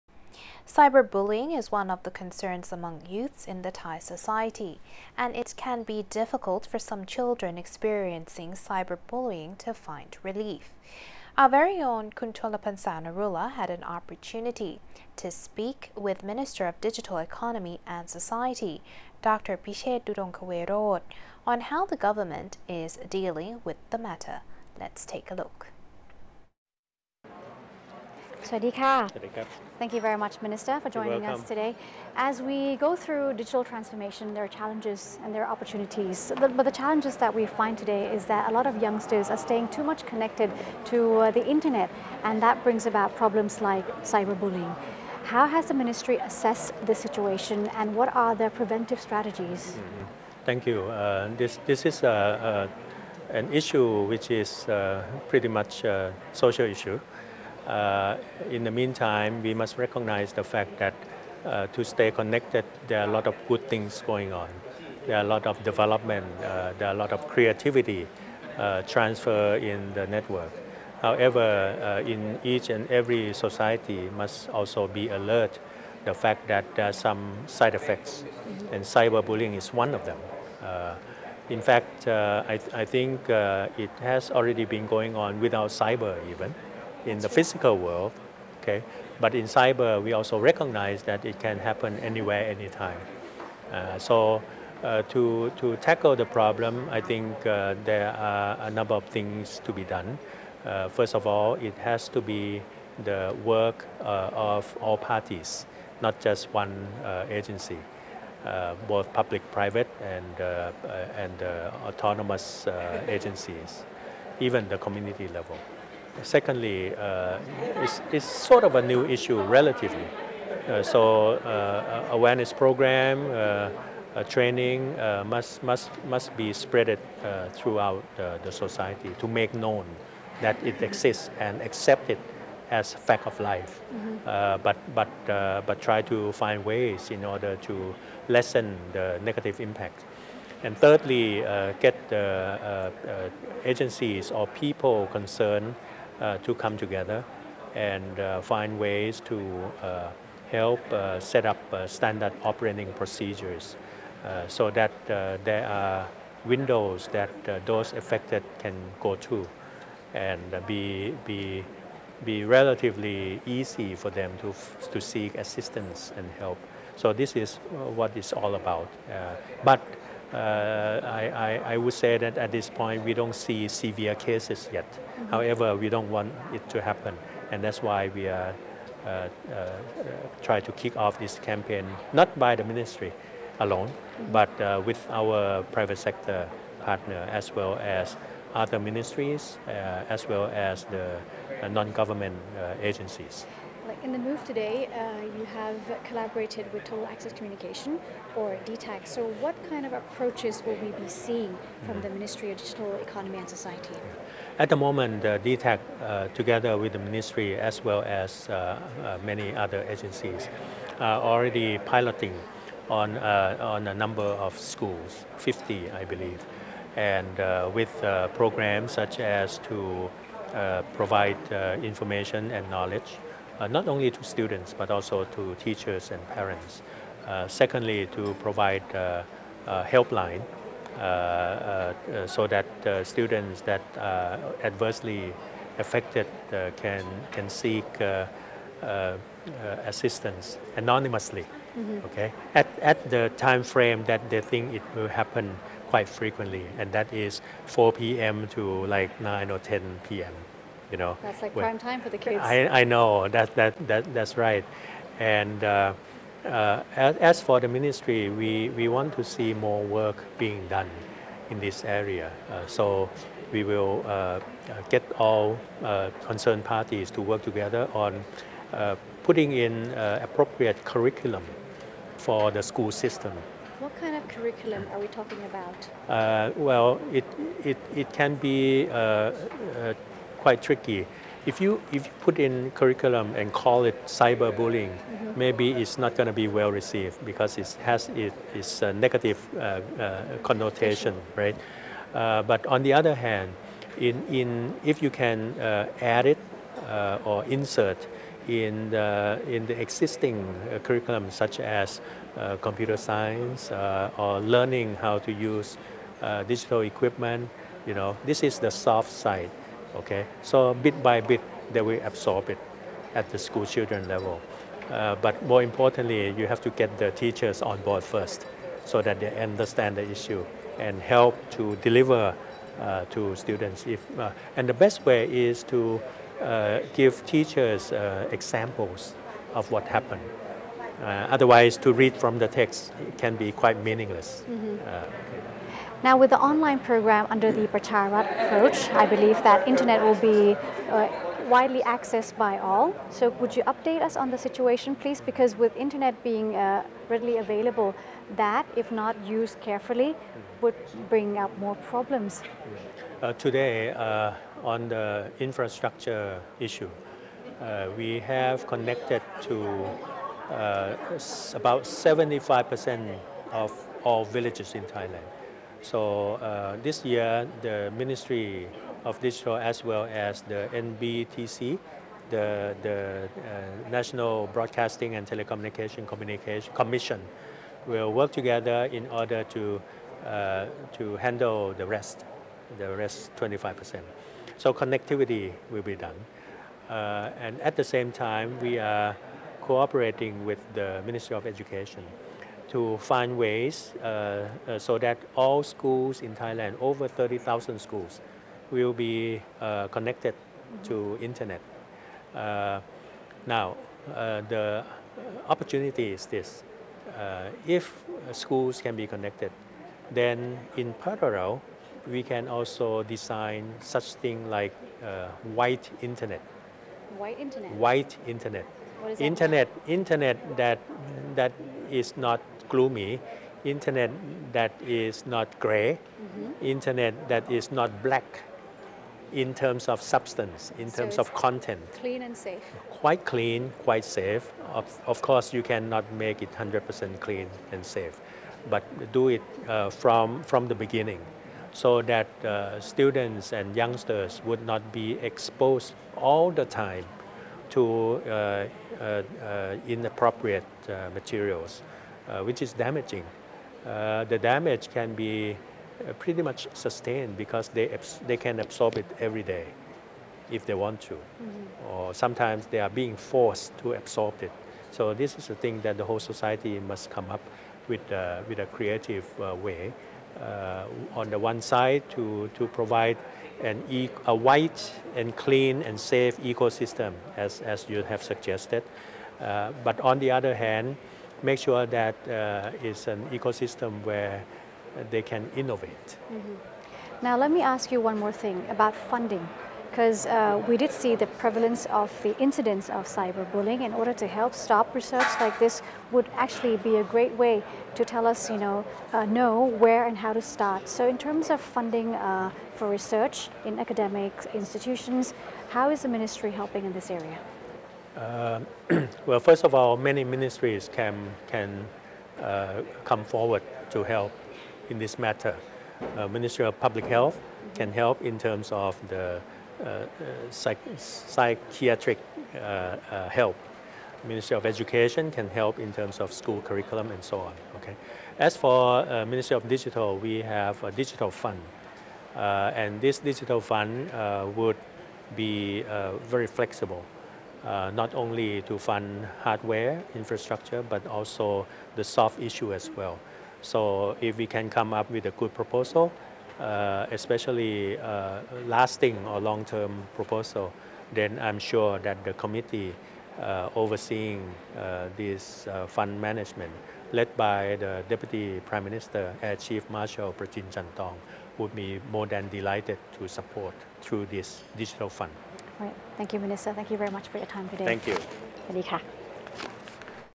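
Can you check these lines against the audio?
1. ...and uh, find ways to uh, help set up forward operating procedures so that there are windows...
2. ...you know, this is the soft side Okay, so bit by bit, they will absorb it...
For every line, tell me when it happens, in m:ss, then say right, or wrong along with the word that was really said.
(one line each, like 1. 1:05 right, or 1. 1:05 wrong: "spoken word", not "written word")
1. 2:27 wrong: "standard", not "forward"
2. 5:07 right.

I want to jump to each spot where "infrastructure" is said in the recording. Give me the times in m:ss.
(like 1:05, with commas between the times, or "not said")
5:55, 9:00.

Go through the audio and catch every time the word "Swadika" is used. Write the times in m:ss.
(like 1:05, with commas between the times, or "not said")
0:28.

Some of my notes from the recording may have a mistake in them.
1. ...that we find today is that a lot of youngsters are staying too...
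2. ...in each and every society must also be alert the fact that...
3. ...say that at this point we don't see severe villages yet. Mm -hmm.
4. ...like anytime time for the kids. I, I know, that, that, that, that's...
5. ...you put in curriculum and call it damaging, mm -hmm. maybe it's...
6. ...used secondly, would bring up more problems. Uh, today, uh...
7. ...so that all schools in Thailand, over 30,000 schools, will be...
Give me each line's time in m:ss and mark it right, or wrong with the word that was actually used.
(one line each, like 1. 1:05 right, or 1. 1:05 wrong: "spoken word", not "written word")
1. 0:37 right
2. 1:12 right
3. 2:51 wrong: "cases", not "villages"
4. 4:11 wrong: "prime", not "anytime"
5. 4:42 wrong: "cyberbullying", not "damaging"
6. 5:49 wrong: "carefully", not "secondly"
7. 6:34 right.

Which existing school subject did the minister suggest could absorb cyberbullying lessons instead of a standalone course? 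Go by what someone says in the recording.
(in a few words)
computer science.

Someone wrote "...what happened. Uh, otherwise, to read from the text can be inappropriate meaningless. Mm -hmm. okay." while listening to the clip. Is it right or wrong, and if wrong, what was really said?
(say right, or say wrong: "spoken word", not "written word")
wrong: "quite", not "inappropriate".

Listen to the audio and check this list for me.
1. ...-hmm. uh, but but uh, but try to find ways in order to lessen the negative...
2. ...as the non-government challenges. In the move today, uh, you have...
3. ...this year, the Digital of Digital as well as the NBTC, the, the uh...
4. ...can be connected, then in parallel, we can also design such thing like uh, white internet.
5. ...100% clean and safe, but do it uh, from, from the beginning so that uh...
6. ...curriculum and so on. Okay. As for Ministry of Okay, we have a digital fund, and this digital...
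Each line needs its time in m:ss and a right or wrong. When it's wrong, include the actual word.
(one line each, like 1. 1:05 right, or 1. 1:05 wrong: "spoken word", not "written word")
1. 2:13 right
2. 3:10 wrong: "agencies", not "challenges"
3. 6:06 wrong: "Ministry", not "Digital"
4. 6:48 right
5. 7:16 right
6. 8:46 wrong: "Digital", not "Okay".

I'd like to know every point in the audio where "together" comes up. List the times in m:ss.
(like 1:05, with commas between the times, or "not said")
2:26, 3:26, 4:27, 6:18.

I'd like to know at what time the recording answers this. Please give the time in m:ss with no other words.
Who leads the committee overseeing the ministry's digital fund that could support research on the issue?
9:20.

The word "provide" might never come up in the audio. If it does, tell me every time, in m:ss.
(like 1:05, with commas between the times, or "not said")
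3:40, 3:48, 7:52.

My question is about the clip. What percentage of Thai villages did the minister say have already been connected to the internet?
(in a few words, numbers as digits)
75%.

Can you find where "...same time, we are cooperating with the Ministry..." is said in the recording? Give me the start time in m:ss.
6:27.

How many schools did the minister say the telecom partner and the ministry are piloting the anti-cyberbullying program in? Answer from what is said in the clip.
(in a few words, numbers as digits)
50.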